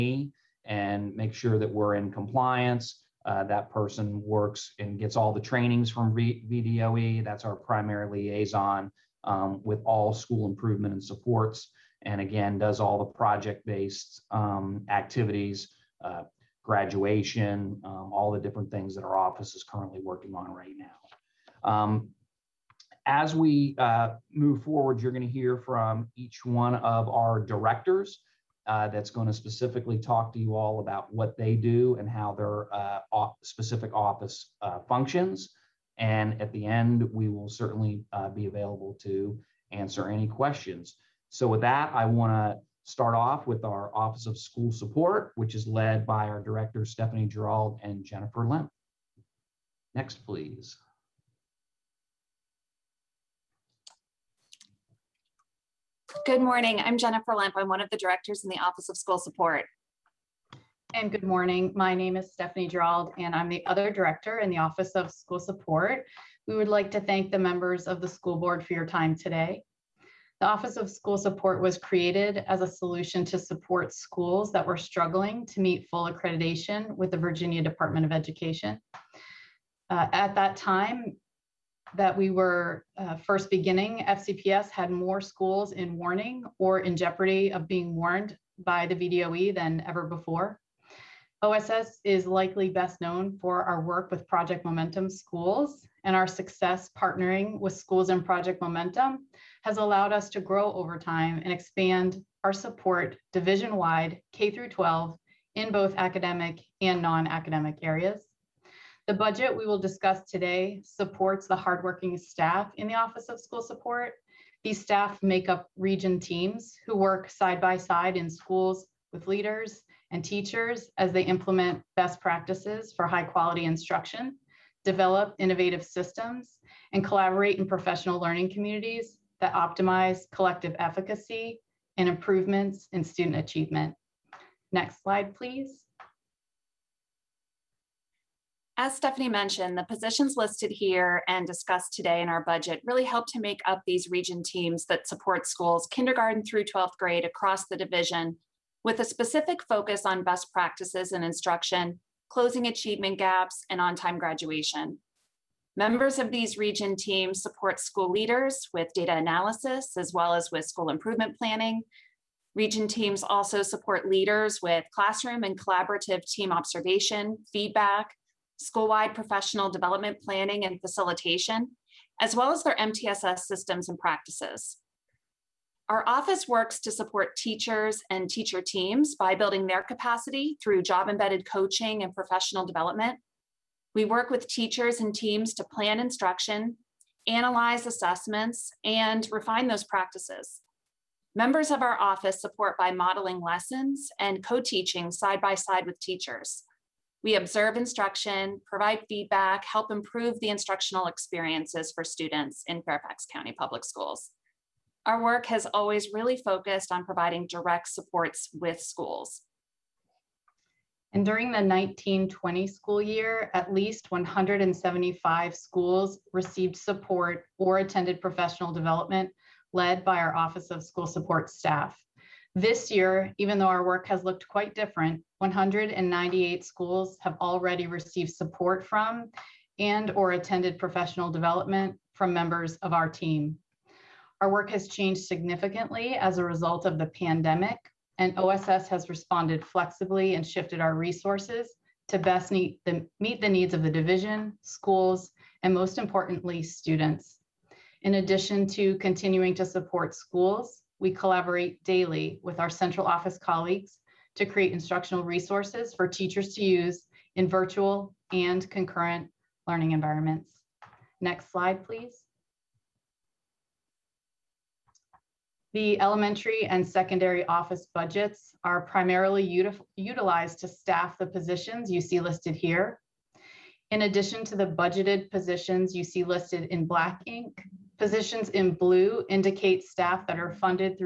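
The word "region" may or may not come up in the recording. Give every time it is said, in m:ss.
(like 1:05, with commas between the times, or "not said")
1:55, 2:24, 2:36, 2:42.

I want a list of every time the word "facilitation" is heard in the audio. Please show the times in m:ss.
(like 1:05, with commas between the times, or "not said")
2:50.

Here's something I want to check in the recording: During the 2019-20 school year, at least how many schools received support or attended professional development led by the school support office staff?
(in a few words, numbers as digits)
175.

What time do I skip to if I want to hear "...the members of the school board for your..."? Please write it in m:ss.
1:07.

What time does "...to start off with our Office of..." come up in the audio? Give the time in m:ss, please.
0:42.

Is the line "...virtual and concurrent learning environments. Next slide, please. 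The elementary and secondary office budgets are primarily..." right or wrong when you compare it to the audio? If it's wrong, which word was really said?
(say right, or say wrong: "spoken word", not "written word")
right.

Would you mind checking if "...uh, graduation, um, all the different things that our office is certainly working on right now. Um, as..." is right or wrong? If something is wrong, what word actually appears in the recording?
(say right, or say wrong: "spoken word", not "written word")
wrong: "currently", not "certainly".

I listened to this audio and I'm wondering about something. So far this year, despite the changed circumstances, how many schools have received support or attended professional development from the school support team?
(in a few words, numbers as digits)
198.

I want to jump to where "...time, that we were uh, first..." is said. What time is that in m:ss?
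1:20.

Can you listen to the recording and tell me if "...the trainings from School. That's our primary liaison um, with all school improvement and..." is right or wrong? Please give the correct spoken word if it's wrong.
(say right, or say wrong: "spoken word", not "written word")
wrong: "VDOE", not "School".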